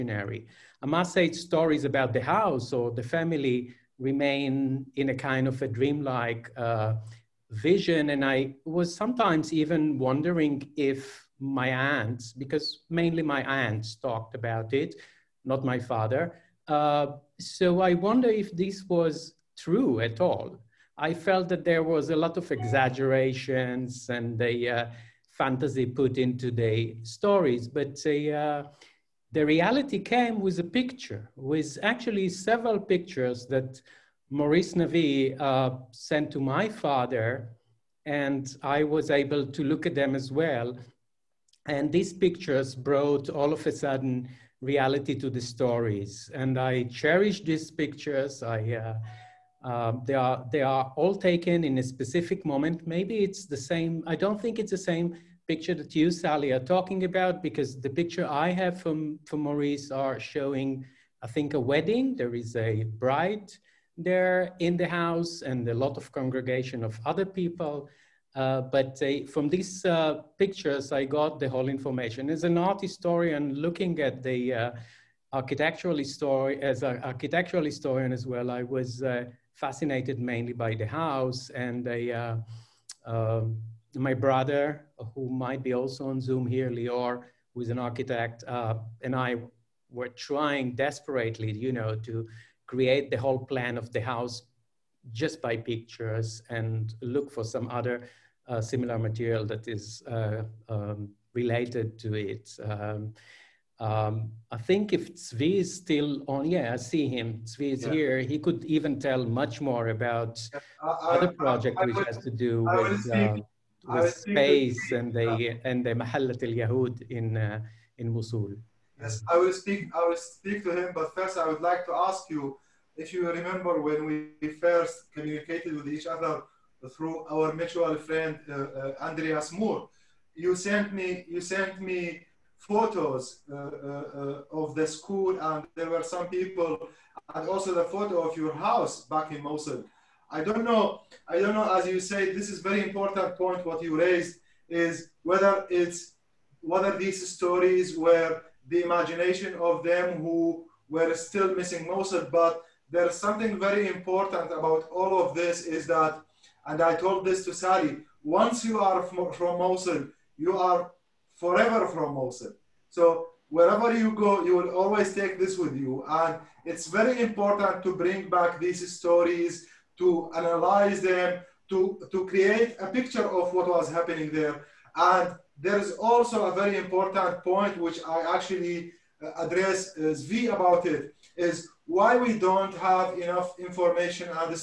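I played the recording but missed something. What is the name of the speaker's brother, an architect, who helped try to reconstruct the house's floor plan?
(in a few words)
Lior.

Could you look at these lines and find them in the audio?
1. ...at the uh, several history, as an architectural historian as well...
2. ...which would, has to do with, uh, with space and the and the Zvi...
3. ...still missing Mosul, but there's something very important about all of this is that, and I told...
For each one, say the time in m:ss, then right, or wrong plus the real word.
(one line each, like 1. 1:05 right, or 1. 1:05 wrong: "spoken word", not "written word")
1. 1:13 wrong: "architectural", not "several"
2. 1:51 wrong: "Mahallat", not "Zvi"
3. 2:31 right.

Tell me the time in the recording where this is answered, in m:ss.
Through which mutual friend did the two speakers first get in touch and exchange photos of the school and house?
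2:09.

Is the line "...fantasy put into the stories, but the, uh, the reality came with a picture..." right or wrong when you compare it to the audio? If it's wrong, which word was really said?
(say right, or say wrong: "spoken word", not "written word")
right.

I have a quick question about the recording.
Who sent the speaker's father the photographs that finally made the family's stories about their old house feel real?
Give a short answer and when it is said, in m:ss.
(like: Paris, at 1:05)
Maurice Navi, at 0:34.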